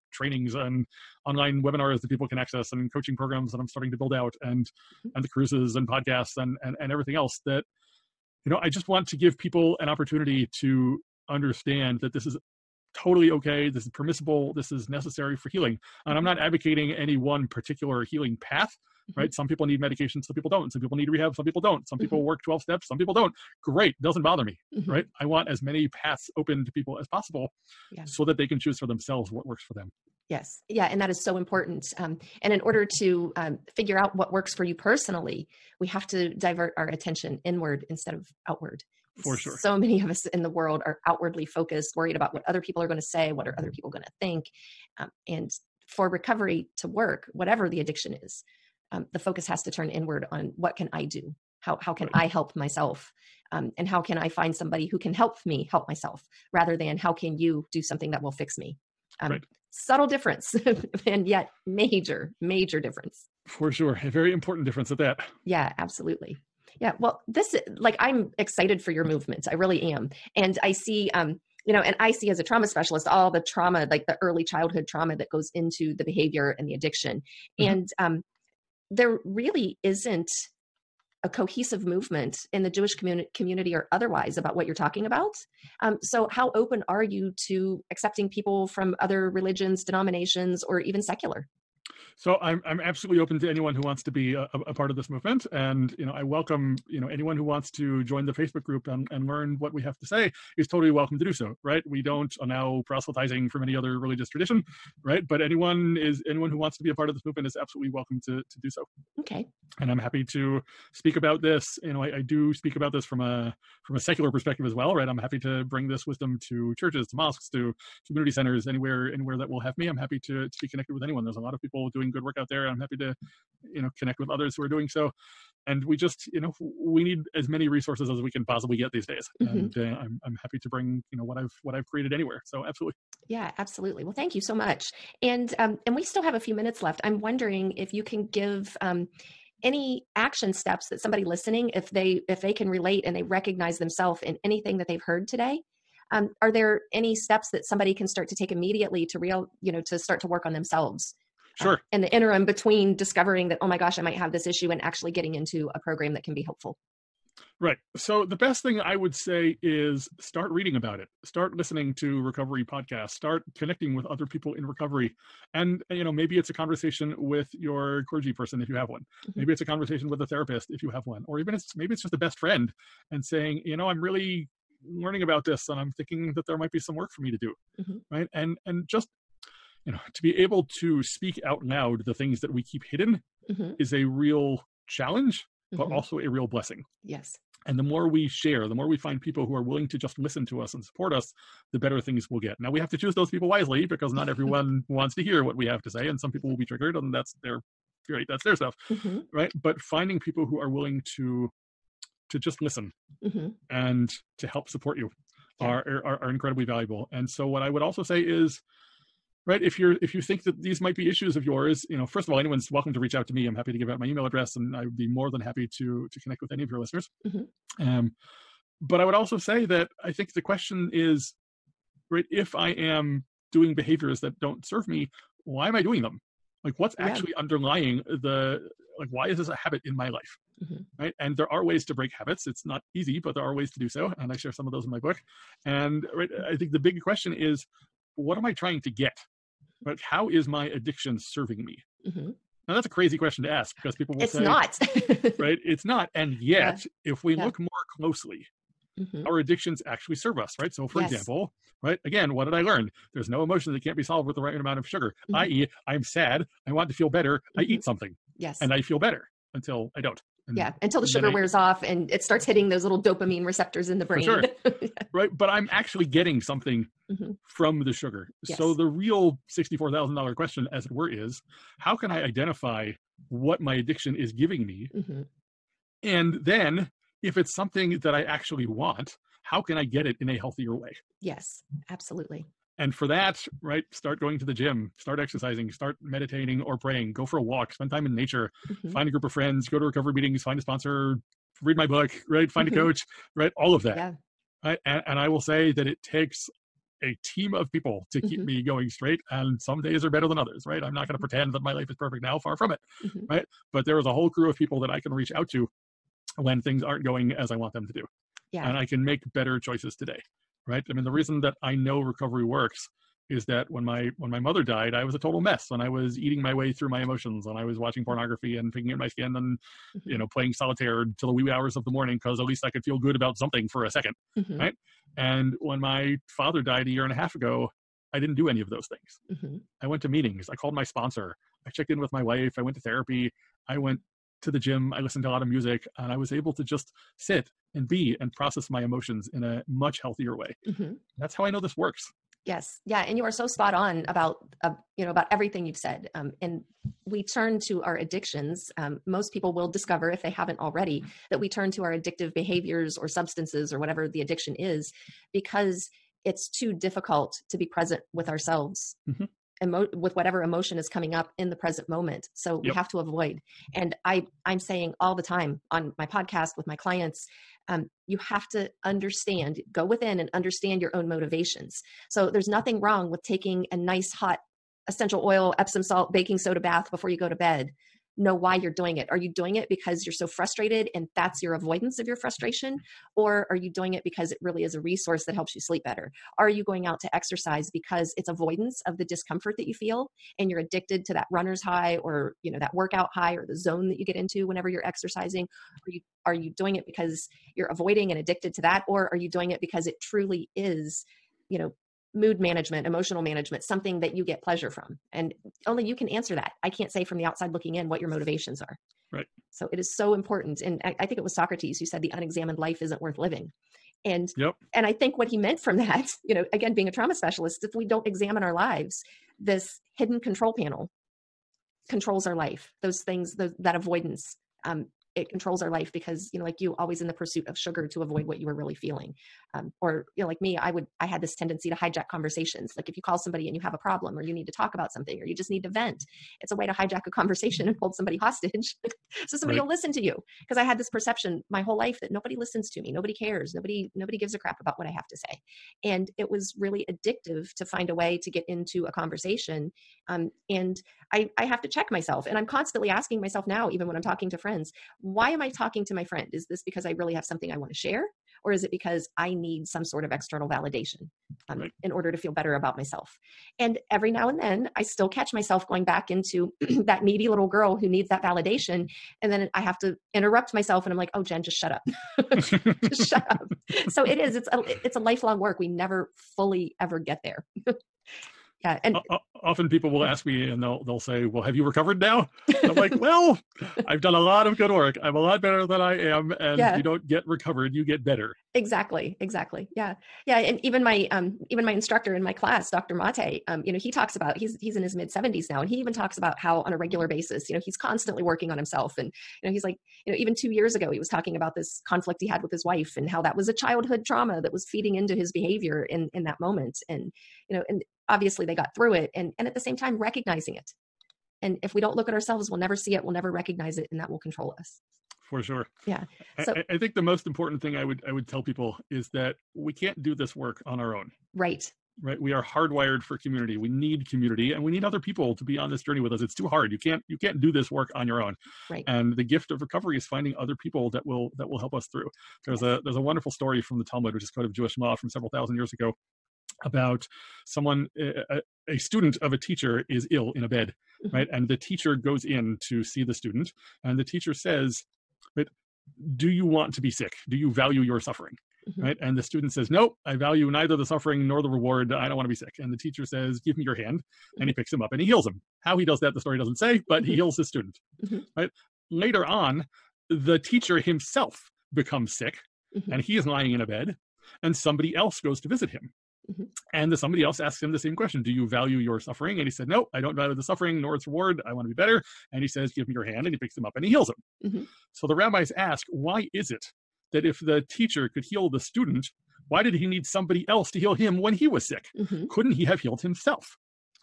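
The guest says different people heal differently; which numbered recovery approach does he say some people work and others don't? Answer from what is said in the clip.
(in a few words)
12 steps.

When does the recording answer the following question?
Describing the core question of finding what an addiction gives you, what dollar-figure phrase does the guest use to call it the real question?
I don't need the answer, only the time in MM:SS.
04:29.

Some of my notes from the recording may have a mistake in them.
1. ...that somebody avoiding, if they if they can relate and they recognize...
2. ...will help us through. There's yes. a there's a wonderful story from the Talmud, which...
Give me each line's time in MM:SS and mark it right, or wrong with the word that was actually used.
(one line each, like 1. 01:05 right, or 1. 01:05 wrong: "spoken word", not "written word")
1. 02:20 wrong: "listening", not "avoiding"
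2. 08:51 right.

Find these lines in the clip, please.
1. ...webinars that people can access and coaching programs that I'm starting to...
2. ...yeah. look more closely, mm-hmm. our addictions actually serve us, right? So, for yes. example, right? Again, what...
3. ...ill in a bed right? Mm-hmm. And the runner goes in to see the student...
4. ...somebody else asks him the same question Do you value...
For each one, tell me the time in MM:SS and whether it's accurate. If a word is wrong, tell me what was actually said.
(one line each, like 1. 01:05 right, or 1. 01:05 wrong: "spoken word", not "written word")
1. 00:01 right
2. 04:07 right
3. 09:00 wrong: "teacher", not "runner"
4. 09:26 right.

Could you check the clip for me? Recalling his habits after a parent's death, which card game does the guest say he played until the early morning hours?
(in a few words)
solitaire.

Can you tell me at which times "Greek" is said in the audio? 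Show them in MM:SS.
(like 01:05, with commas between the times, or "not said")
not said.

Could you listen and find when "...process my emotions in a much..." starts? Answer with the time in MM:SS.
05:38.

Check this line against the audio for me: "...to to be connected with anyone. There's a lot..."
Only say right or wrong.
right.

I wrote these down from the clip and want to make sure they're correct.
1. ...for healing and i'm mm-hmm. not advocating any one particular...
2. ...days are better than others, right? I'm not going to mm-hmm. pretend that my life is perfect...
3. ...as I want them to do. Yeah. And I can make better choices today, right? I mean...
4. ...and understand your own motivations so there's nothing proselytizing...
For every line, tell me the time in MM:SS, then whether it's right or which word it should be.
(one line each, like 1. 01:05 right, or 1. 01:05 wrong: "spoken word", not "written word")
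1. 00:15 right
2. 04:59 right
3. 05:07 right
4. 06:10 wrong: "wrong", not "proselytizing".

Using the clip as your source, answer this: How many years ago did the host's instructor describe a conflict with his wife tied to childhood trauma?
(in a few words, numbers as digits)
2.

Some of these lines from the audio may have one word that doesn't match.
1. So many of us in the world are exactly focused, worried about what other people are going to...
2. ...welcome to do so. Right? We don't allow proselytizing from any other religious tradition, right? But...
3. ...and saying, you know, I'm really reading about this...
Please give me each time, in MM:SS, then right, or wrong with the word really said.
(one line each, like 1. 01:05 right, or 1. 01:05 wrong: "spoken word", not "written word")
1. 00:39 wrong: "outwardly", not "exactly"
2. 01:40 right
3. 02:53 wrong: "learning", not "reading".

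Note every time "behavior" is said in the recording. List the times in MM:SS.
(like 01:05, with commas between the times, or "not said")
01:16, 03:43, 05:52, 08:25.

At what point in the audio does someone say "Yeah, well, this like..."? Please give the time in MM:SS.
01:06.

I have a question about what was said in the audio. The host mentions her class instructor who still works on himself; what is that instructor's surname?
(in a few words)
Mate.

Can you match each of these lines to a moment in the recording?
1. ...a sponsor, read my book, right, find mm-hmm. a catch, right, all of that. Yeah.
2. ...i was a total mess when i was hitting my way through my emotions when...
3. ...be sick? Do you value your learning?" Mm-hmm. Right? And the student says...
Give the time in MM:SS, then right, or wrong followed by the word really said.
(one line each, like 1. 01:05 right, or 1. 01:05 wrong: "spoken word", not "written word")
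1. 04:50 wrong: "coach", not "catch"
2. 05:14 wrong: "eating", not "hitting"
3. 09:06 wrong: "suffering", not "learning".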